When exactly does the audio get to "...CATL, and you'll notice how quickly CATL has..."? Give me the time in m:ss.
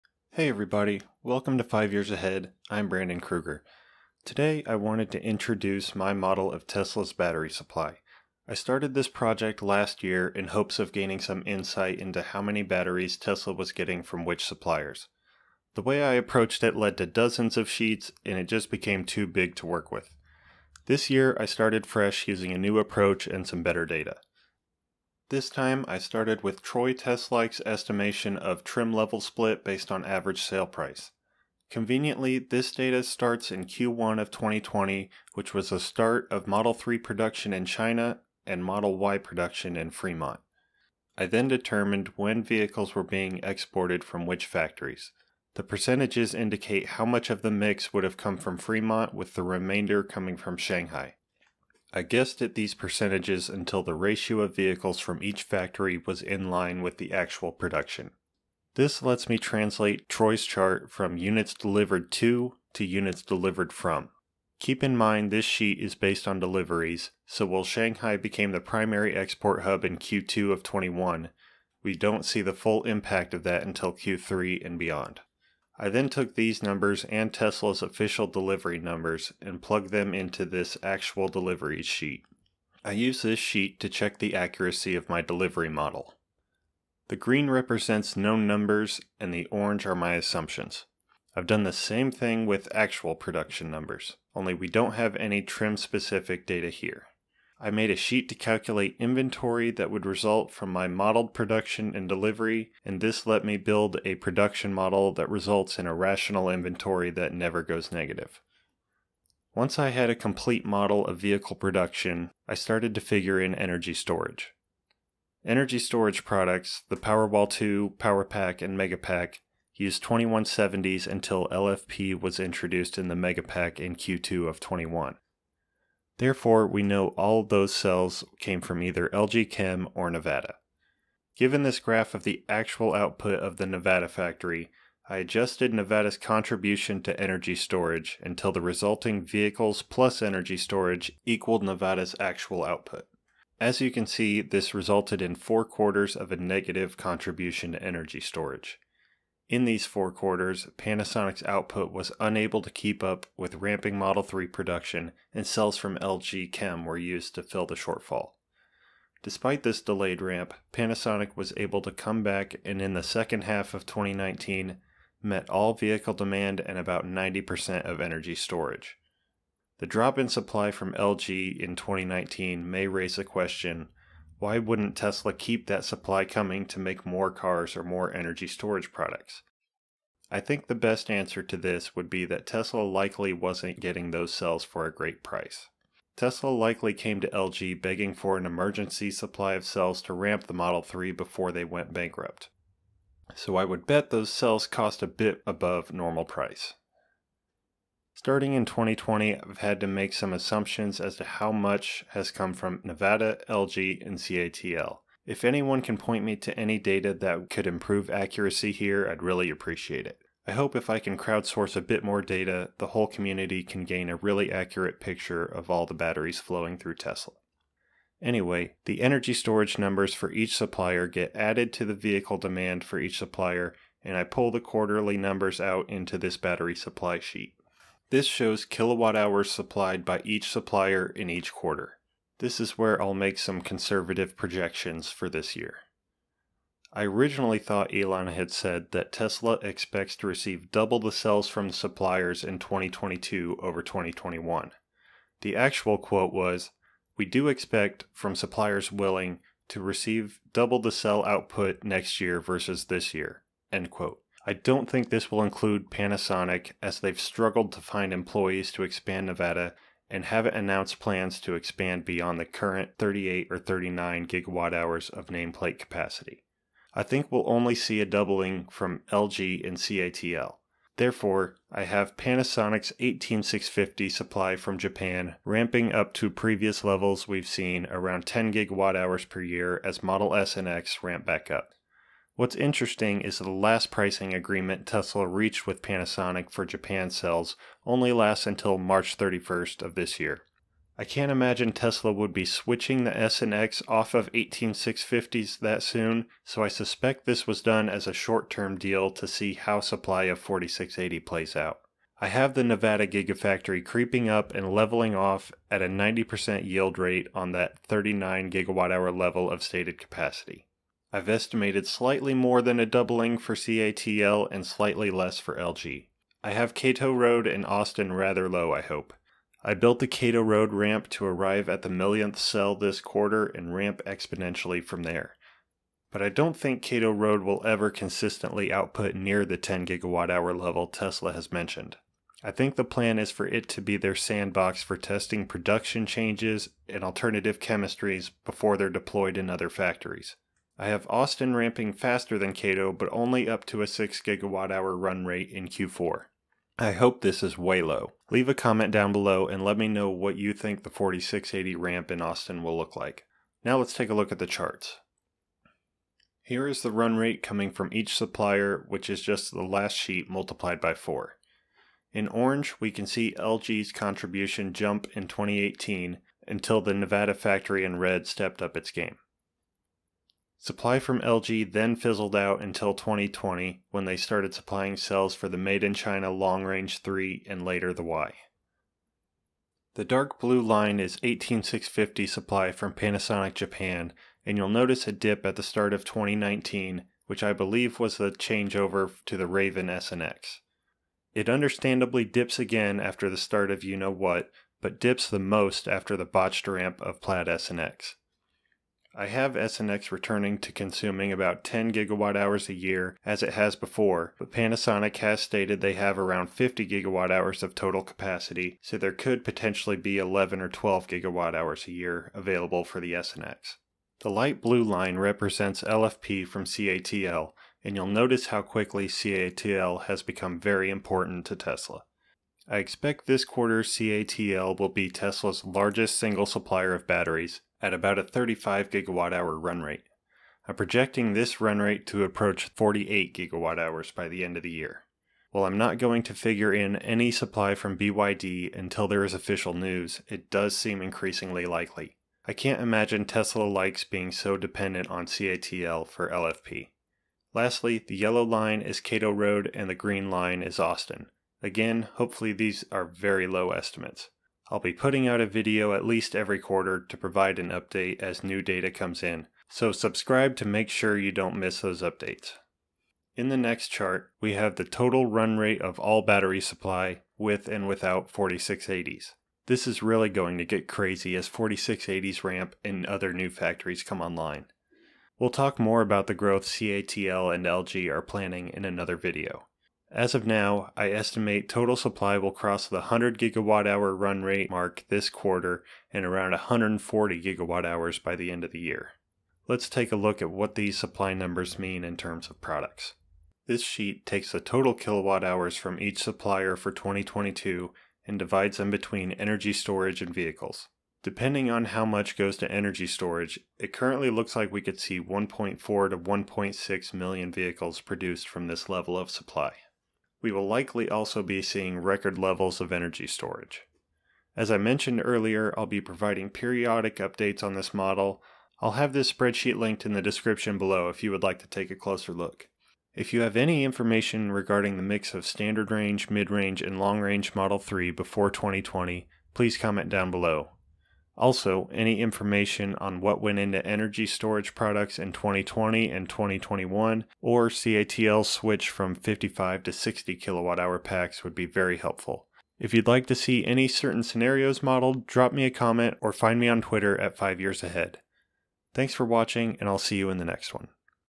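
6:56.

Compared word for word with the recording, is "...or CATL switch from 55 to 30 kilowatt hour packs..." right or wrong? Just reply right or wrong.
wrong.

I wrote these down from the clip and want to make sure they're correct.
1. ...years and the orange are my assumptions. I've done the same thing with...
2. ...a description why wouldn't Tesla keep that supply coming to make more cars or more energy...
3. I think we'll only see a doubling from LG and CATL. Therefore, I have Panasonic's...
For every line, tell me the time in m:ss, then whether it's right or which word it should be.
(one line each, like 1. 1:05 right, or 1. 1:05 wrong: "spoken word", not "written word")
1. 1:28 wrong: "numbers", not "years"
2. 2:53 wrong: "question", not "description"
3. 4:26 right.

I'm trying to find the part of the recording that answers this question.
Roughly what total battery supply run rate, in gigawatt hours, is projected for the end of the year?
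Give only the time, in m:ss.
8:06.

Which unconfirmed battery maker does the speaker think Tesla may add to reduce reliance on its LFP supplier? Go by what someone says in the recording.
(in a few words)
BYD.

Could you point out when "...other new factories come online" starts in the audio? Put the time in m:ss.
7:53.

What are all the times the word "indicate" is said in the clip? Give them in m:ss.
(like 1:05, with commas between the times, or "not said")
0:46.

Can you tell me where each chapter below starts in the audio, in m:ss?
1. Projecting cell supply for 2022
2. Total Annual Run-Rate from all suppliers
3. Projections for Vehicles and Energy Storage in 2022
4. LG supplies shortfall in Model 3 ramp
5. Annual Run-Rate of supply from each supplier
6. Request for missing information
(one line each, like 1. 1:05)
1. 3:52
2. 7:44
3. 8:14
4. 2:24
5. 5:54
6. 8:44.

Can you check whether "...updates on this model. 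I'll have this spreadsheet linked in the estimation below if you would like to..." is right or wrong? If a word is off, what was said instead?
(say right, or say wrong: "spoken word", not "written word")
wrong: "description", not "estimation".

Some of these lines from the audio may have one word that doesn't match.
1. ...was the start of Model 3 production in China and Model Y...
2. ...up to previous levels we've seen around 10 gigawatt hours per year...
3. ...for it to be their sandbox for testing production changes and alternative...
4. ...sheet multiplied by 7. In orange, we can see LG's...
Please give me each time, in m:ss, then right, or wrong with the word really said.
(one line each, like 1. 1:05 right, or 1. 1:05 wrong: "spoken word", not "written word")
1. 0:35 right
2. 4:35 right
3. 5:33 right
4. 5:59 wrong: "4", not "7".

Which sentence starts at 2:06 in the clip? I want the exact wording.
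Therefore, we know all those cells came from either LG Chem or Nevada.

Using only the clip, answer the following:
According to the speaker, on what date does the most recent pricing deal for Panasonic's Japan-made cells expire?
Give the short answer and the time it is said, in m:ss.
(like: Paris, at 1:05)
March 31st, at 4:48.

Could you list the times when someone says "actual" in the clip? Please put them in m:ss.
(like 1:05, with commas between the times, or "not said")
0:57, 1:20, 1:32, 2:12, 2:22, 4:05.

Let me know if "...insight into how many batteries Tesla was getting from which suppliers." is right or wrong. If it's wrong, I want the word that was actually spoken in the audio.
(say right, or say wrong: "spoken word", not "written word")
right.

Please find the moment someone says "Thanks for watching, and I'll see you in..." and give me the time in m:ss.
9:08.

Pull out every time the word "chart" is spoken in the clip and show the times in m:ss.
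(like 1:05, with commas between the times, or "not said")
1:00, 5:54, 7:43.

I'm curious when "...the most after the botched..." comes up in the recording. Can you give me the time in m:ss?
6:35.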